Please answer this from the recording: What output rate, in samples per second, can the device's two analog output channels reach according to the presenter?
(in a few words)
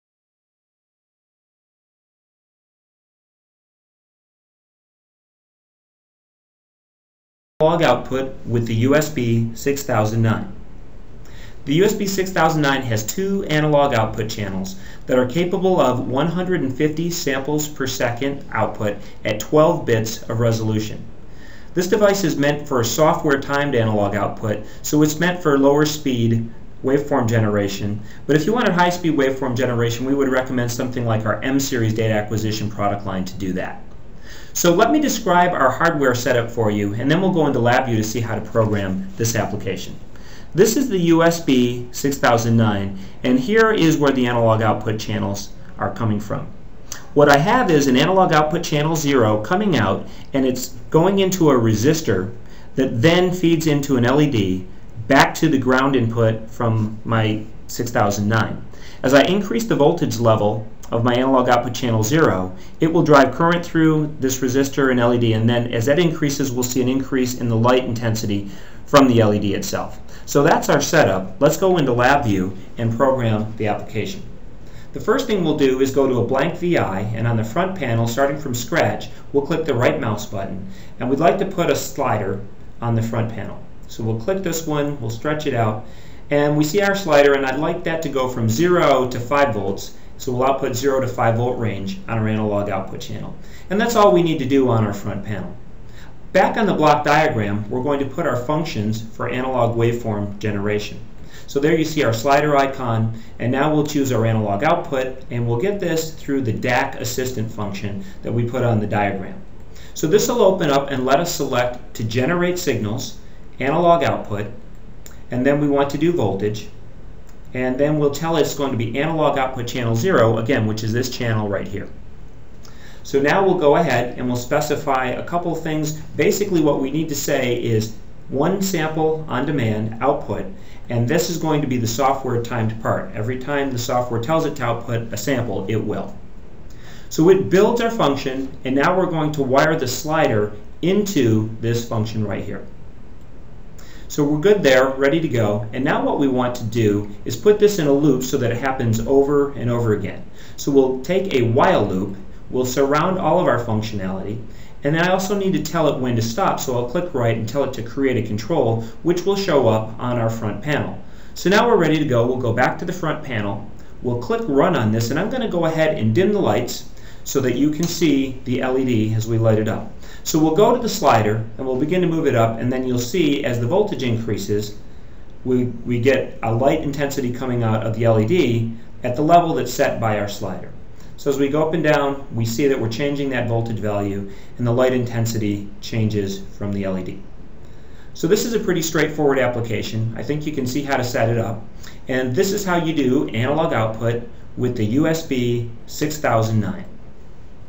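150.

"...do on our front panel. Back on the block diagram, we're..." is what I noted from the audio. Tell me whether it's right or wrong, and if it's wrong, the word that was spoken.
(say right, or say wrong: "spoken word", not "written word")
right.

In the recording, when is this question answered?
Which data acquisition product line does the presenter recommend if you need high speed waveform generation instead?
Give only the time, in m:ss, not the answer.
0:31.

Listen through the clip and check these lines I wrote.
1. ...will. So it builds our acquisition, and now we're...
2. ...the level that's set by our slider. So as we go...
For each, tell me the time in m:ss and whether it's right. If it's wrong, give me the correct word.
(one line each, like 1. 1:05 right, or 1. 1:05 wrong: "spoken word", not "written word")
1. 2:15 wrong: "function", not "acquisition"
2. 2:59 right.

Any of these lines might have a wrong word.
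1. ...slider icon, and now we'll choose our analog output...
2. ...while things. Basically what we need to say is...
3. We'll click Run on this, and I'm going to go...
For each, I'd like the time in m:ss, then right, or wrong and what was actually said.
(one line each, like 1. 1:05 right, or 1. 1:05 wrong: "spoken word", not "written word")
1. 1:42 right
2. 2:05 wrong: "couple", not "while"
3. 2:44 right.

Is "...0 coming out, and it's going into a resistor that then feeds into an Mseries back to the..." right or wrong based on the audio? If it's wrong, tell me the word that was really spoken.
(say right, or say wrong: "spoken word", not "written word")
wrong: "LED", not "Mseries".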